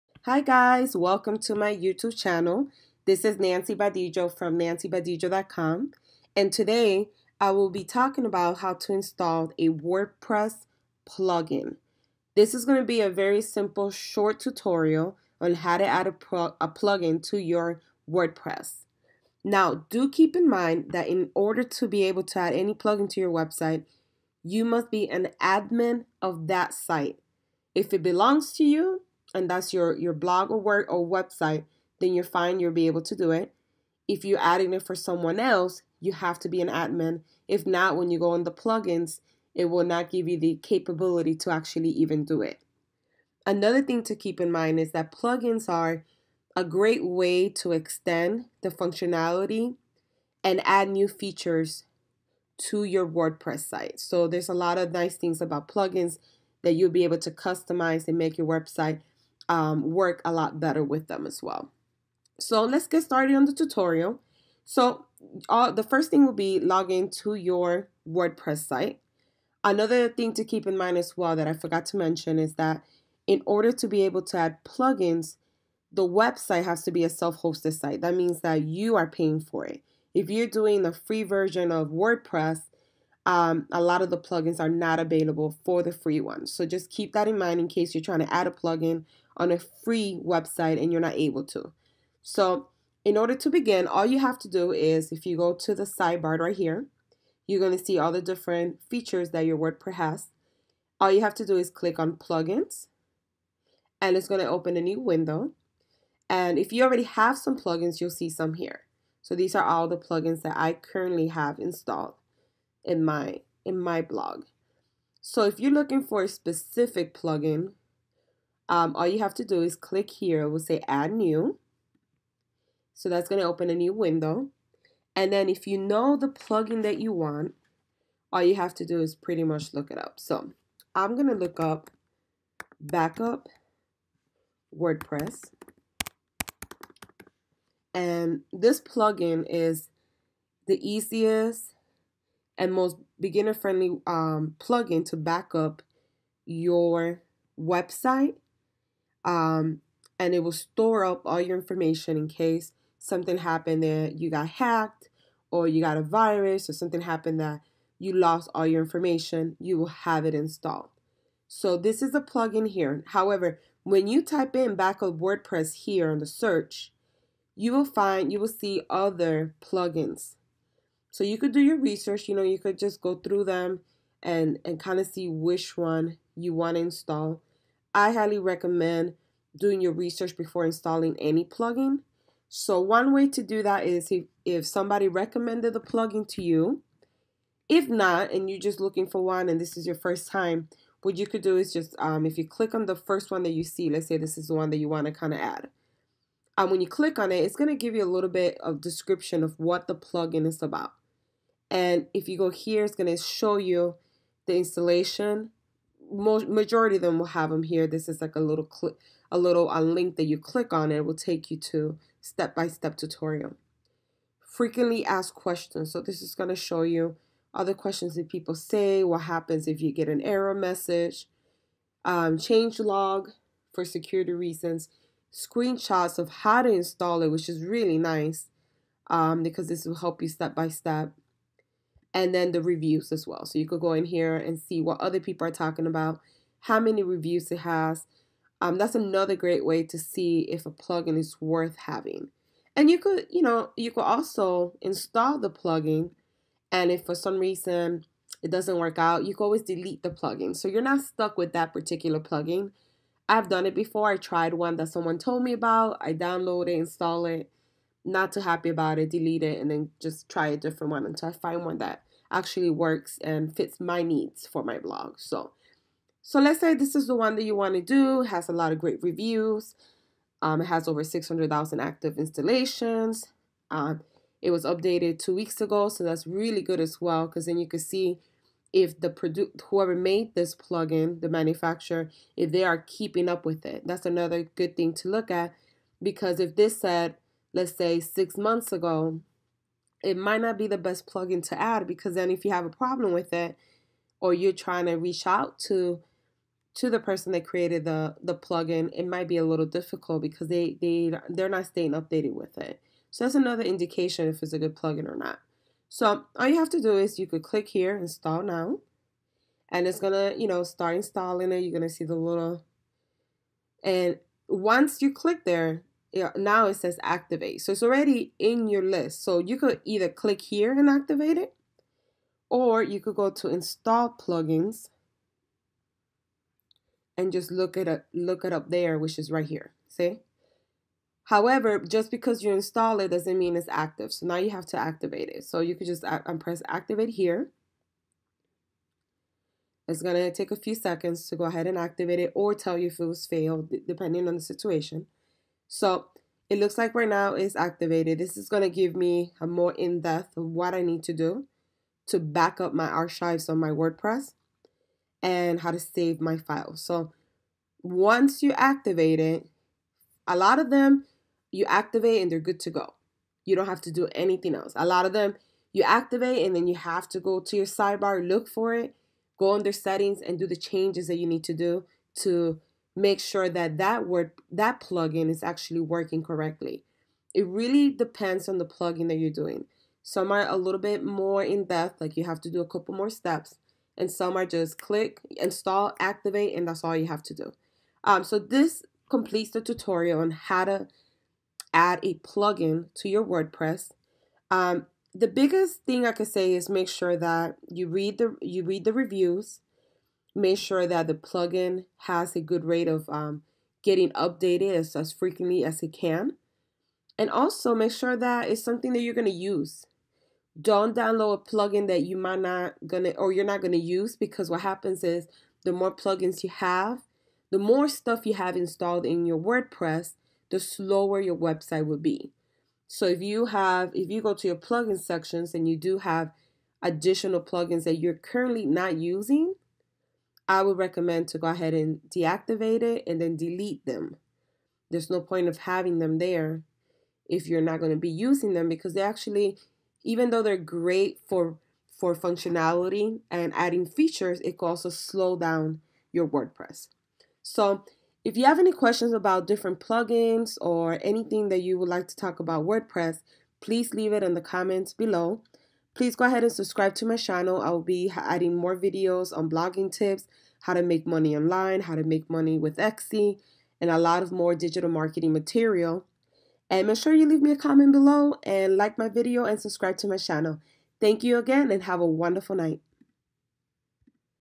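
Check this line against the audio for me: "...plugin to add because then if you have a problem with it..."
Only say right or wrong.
right.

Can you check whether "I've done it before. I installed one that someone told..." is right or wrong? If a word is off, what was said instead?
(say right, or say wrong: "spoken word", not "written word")
wrong: "tried", not "installed".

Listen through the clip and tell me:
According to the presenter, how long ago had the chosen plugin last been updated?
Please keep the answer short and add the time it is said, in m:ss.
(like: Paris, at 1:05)
two weeks ago, at 4:35.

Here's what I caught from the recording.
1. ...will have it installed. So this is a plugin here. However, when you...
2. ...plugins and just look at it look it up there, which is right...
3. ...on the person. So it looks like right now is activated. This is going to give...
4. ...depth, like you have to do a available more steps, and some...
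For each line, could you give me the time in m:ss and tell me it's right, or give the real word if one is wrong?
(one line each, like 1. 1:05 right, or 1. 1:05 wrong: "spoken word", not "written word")
1. 2:39 right
2. 5:24 right
3. 5:44 wrong: "situation", not "person"
4. 6:21 wrong: "couple", not "available".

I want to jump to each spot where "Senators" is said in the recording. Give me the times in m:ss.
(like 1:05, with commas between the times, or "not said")
not said.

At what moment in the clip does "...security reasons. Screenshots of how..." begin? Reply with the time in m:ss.
3:43.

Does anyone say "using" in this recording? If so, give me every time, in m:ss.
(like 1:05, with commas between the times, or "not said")
7:08, 7:18.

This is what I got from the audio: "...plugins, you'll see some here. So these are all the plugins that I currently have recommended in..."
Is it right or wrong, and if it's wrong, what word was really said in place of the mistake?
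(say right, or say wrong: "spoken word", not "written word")
wrong: "installed", not "recommended".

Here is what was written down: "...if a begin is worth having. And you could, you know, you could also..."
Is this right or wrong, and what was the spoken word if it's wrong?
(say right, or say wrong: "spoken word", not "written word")
wrong: "plugin", not "begin".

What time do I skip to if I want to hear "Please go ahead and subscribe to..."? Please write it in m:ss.
7:35.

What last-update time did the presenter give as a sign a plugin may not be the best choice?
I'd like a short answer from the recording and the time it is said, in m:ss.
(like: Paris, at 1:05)
six months ago, at 4:47.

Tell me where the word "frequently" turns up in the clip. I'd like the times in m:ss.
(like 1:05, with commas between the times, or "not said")
3:34, 6:45.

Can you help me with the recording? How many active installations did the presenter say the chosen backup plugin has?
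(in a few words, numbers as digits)
600,000.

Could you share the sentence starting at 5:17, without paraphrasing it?
So it's already in your list.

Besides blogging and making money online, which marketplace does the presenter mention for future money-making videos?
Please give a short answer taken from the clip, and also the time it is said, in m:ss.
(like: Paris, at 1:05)
Etsy, at 7:42.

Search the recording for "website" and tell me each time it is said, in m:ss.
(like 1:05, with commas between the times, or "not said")
0:23, 0:31, 0:58, 1:16, 1:30, 2:27, 7:01.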